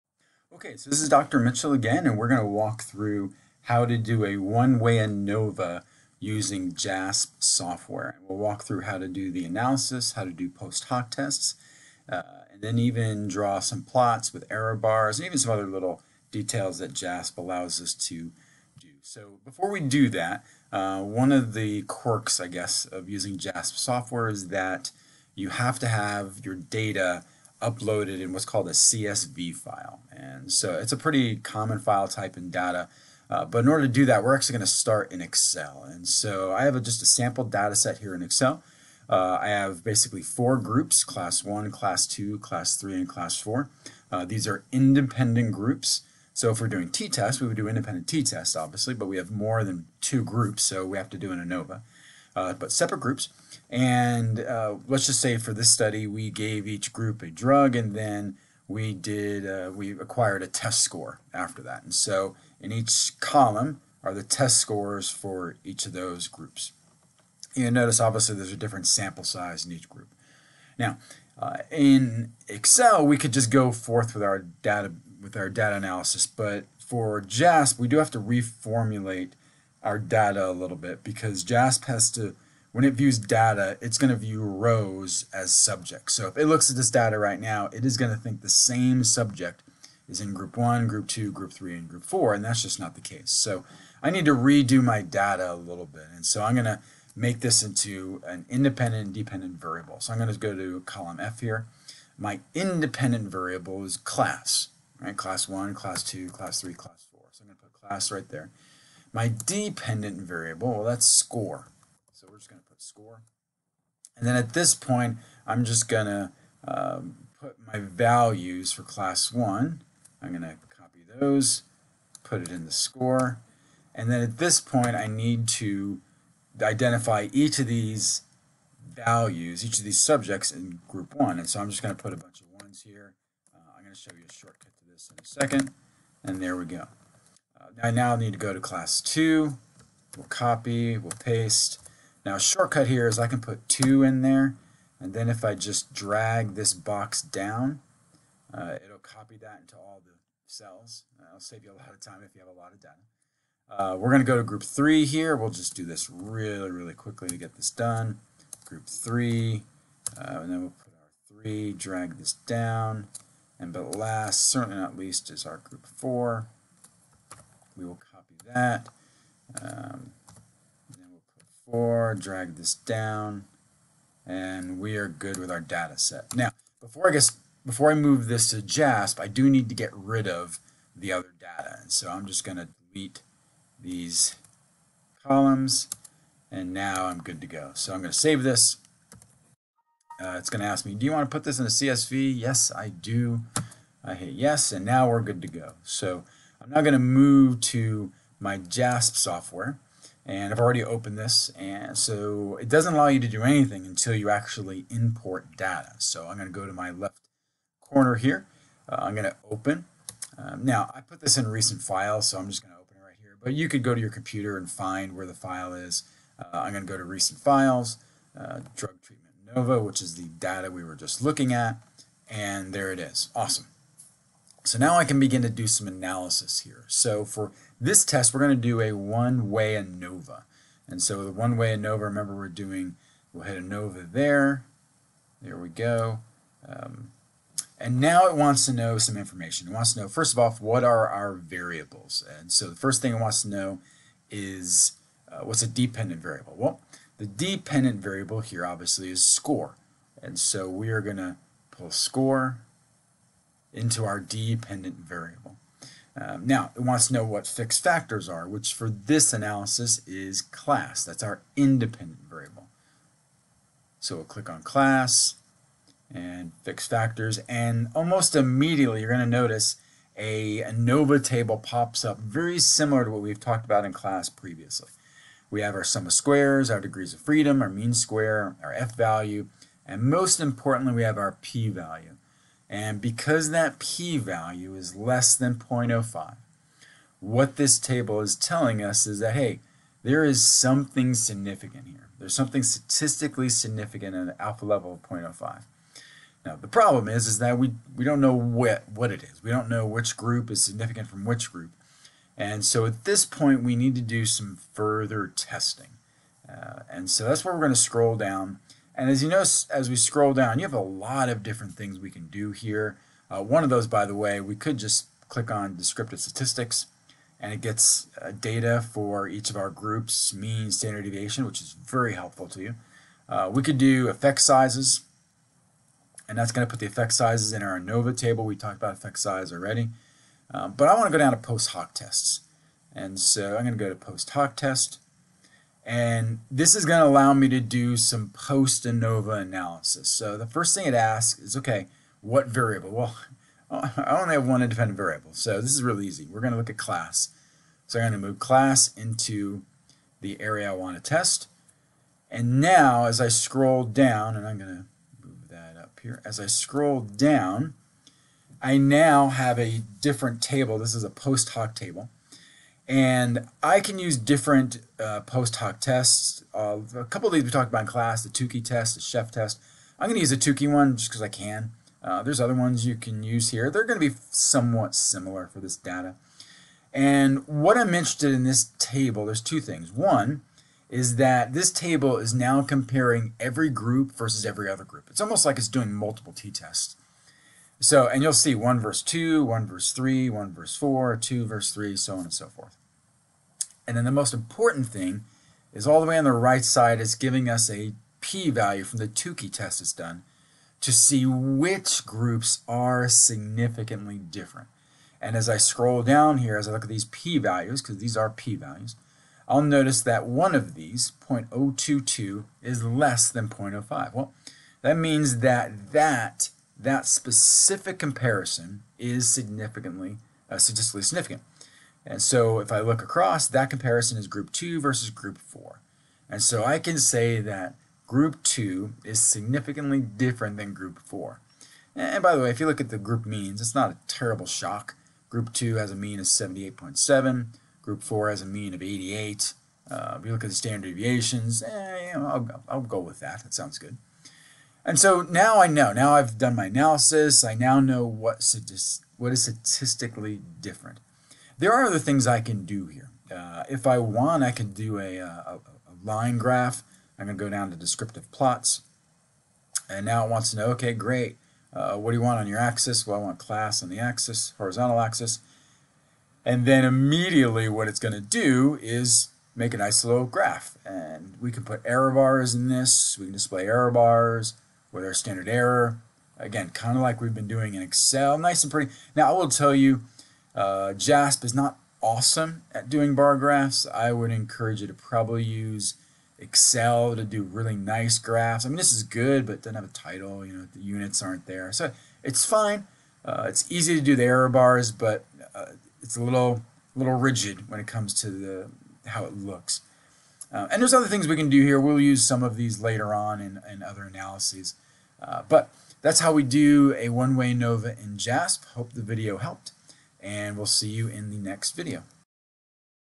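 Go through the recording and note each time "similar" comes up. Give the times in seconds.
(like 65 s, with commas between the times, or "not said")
272 s, 374 s.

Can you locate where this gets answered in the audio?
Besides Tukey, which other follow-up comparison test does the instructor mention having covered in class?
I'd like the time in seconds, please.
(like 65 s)
369 s.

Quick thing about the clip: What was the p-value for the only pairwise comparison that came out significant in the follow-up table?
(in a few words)
0.022.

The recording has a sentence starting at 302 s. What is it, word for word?
And so at this point, we need to do some further testing.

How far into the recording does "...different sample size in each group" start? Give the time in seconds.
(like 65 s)
68 s.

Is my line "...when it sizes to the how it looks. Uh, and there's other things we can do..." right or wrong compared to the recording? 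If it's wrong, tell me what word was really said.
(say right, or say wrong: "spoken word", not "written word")
wrong: "comes", not "sizes".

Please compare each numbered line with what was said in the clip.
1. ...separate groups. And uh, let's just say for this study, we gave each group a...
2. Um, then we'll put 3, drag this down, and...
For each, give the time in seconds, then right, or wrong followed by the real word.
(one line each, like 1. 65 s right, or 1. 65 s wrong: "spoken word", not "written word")
1. 52 s right
2. 169 s wrong: "4", not "3".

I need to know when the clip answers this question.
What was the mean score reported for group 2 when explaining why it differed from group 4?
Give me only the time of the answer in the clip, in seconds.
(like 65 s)
436 s.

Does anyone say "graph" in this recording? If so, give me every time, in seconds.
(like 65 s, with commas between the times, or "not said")
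456 s, 470 s, 483 s, 488 s.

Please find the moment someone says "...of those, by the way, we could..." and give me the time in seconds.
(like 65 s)
313 s.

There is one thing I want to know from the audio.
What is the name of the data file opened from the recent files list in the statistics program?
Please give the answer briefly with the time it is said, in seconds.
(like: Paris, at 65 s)
drug treatment NOVA, at 218 s.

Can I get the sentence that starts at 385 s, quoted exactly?
It's almost like it's doing multiple t-tests.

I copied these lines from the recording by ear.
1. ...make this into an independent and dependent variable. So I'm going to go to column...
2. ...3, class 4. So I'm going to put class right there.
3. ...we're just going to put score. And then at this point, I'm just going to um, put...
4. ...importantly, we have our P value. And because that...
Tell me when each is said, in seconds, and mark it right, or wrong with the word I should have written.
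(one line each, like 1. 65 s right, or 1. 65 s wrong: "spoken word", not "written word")
1. 97 s right
2. 106 s right
3. 112 s right
4. 280 s right.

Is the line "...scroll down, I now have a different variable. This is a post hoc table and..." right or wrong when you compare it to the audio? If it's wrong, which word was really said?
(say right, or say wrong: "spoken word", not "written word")
wrong: "table", not "variable".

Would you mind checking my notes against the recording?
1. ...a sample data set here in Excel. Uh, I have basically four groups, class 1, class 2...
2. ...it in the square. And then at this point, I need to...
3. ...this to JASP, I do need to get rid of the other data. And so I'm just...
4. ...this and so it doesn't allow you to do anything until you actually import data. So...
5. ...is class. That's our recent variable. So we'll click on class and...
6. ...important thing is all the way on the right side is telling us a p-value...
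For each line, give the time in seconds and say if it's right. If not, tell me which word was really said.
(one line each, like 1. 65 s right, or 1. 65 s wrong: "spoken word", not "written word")
1. 37 s right
2. 122 s wrong: "score", not "square"
3. 178 s right
4. 201 s right
5. 260 s wrong: "independent", not "recent"
6. 394 s wrong: "giving", not "telling".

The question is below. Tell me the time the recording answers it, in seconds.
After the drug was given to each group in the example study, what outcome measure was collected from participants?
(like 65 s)
60 s.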